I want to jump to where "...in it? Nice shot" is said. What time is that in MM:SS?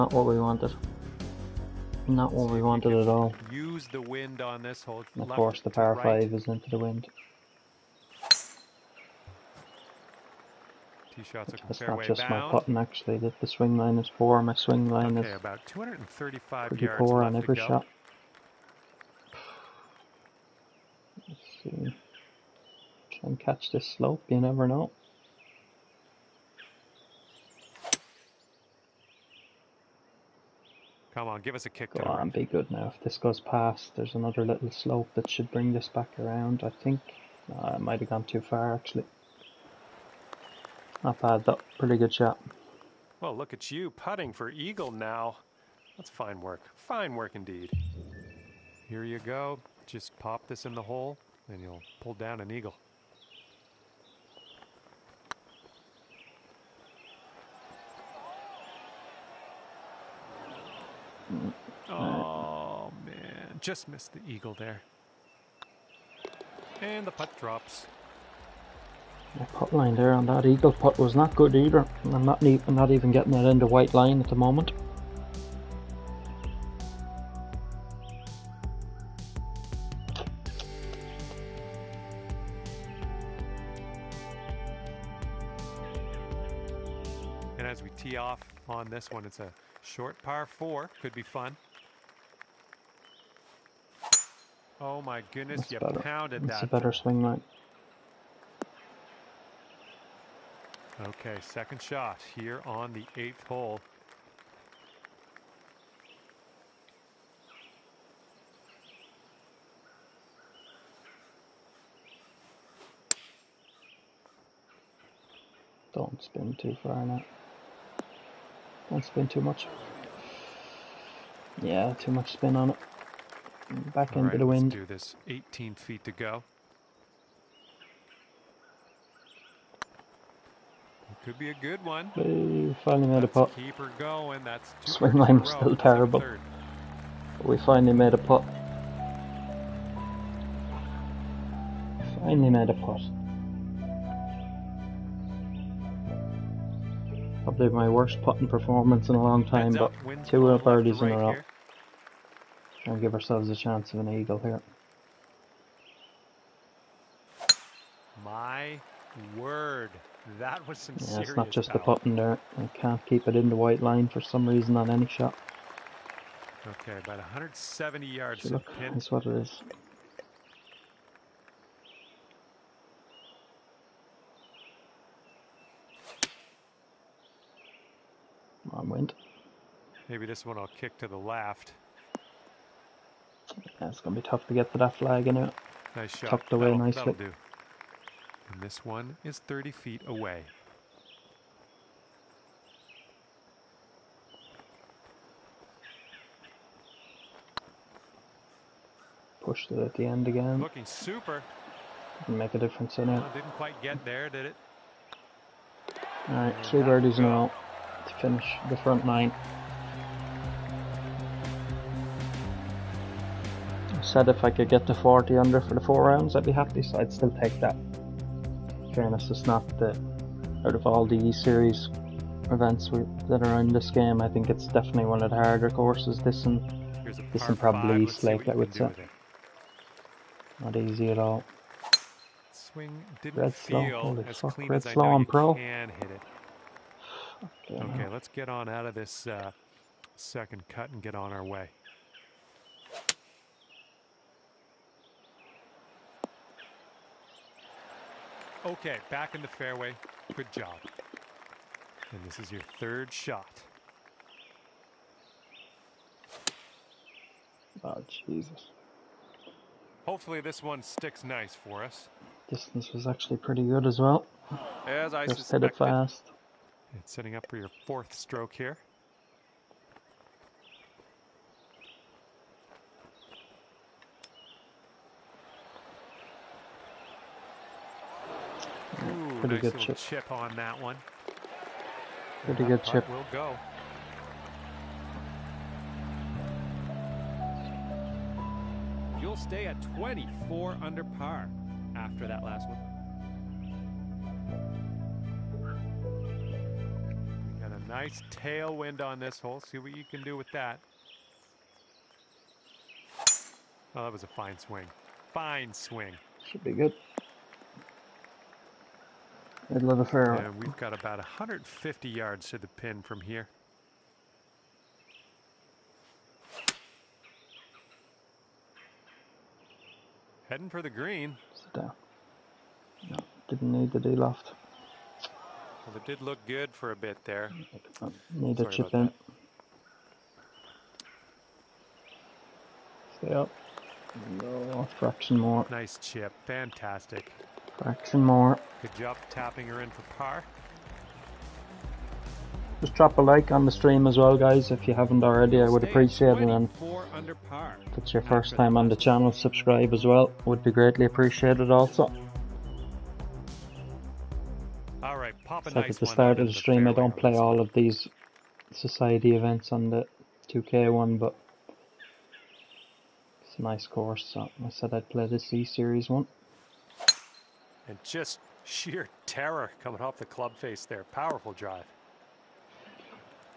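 03:05.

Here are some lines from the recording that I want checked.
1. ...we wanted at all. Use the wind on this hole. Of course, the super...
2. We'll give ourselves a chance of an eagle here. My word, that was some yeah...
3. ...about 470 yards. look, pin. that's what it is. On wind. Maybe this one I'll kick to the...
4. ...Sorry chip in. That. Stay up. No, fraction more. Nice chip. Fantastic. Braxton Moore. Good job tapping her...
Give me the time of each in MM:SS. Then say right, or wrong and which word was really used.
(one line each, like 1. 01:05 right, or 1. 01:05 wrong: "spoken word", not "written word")
1. 00:02 wrong: "power", not "super"
2. 02:32 right
3. 02:46 wrong: "170", not "470"
4. 05:28 right.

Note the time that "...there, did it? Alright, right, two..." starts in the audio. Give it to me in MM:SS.
03:24.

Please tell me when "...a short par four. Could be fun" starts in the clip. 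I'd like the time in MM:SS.
01:29.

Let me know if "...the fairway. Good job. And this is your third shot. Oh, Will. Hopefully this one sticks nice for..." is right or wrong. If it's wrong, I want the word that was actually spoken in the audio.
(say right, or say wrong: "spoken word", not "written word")
wrong: "Jesus", not "Will".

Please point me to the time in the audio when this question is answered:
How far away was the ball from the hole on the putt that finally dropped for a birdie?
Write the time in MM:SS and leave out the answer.
02:05.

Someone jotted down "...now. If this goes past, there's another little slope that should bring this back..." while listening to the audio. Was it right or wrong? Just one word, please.
right.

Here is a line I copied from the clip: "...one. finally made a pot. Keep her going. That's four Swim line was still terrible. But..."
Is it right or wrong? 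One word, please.
wrong.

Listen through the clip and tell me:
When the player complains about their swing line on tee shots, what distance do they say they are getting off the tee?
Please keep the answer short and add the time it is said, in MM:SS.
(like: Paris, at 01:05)
235, at 00:15.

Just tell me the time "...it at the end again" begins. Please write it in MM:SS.
03:19.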